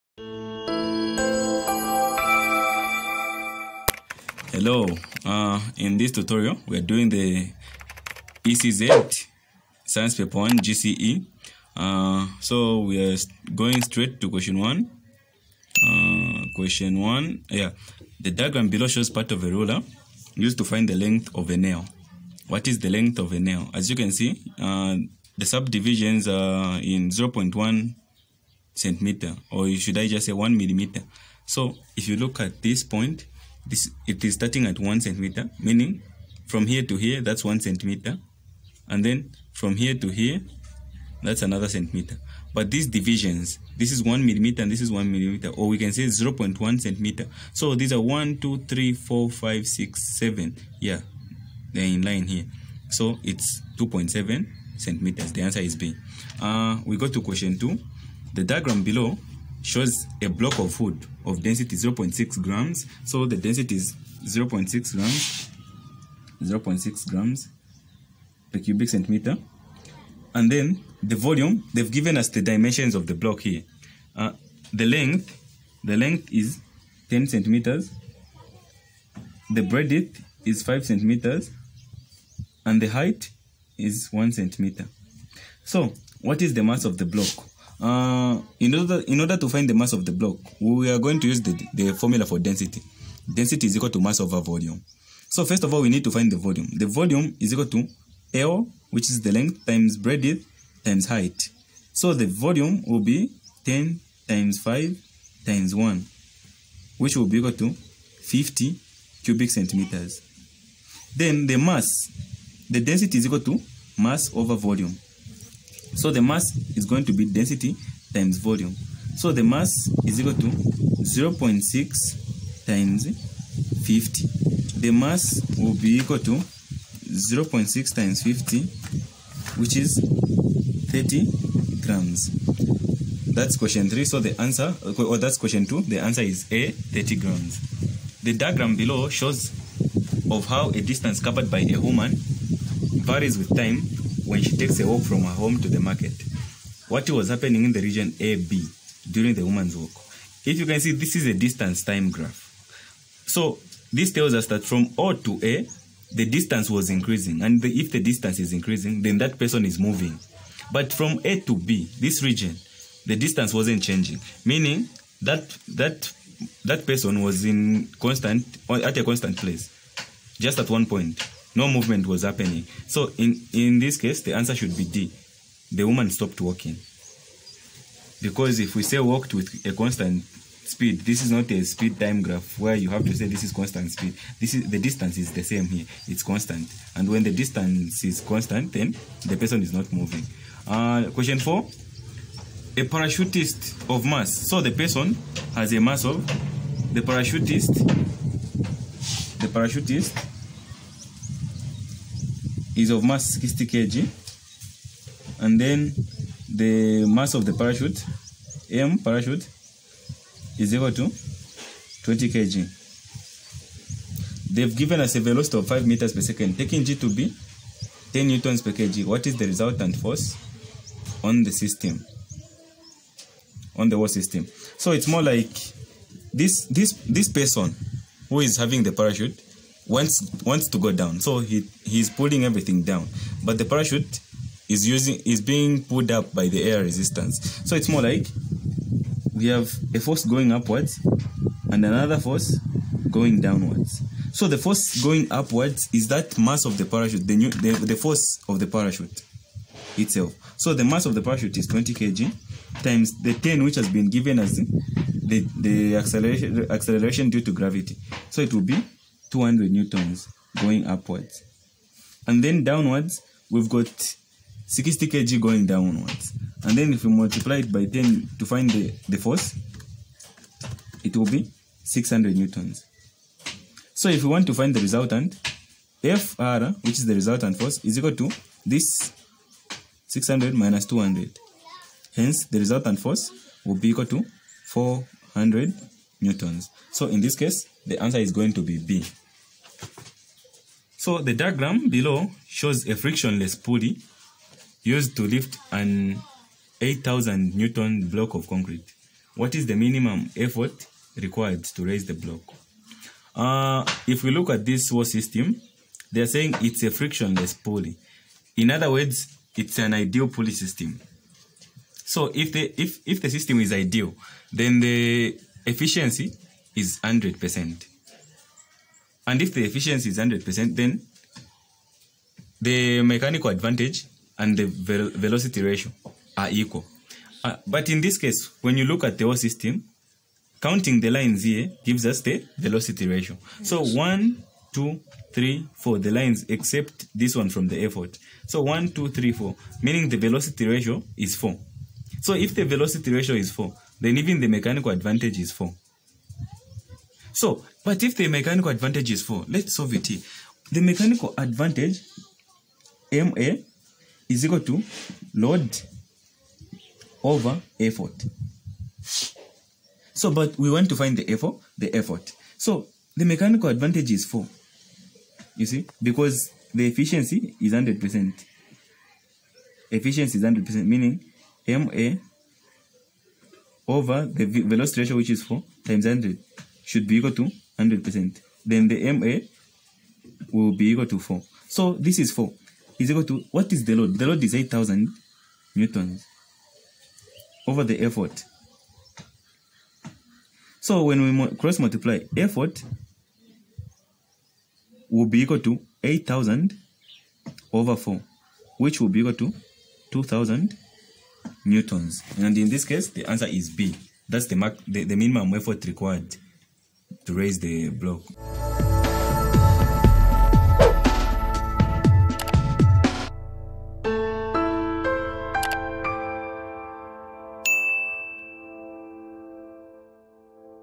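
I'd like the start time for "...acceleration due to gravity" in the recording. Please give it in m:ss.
4:16.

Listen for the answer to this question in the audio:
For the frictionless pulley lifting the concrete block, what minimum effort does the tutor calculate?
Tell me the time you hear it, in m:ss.
6:40.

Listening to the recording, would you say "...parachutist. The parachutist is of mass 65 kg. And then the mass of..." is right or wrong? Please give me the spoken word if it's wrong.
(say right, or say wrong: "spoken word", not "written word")
wrong: "60", not "65".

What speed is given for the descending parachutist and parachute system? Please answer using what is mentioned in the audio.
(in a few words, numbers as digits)
5 meters per second.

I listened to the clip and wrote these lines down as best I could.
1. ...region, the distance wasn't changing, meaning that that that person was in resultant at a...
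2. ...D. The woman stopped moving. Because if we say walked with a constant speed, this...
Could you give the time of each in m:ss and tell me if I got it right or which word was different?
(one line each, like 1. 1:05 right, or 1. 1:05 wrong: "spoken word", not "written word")
1. 2:42 wrong: "constant", not "resultant"
2. 2:54 wrong: "walking", not "moving".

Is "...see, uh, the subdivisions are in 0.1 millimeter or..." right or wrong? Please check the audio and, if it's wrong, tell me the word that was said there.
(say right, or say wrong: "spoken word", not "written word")
wrong: "centimeter", not "millimeter".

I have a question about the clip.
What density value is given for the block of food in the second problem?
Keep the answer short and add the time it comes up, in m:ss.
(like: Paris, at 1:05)
0.6 grams per cubic centimeter, at 1:06.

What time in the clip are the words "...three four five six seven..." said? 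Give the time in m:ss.
0:48.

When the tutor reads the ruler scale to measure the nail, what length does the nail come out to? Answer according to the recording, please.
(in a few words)
2.7 centimeters.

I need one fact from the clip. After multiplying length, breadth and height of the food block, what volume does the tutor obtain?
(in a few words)
50 cubic centimeters.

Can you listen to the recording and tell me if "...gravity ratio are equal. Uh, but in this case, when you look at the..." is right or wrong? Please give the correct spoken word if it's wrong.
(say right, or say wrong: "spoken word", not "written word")
wrong: "velocity", not "gravity".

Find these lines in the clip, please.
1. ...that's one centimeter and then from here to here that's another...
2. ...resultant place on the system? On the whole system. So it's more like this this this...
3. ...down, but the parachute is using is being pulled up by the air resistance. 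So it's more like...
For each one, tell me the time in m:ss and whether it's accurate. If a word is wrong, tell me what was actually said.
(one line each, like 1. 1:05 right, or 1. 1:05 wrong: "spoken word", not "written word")
1. 0:37 right
2. 3:39 wrong: "force", not "place"
3. 3:52 right.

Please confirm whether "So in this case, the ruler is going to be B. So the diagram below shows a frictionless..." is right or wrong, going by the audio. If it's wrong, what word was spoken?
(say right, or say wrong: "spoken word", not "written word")
wrong: "answer", not "ruler".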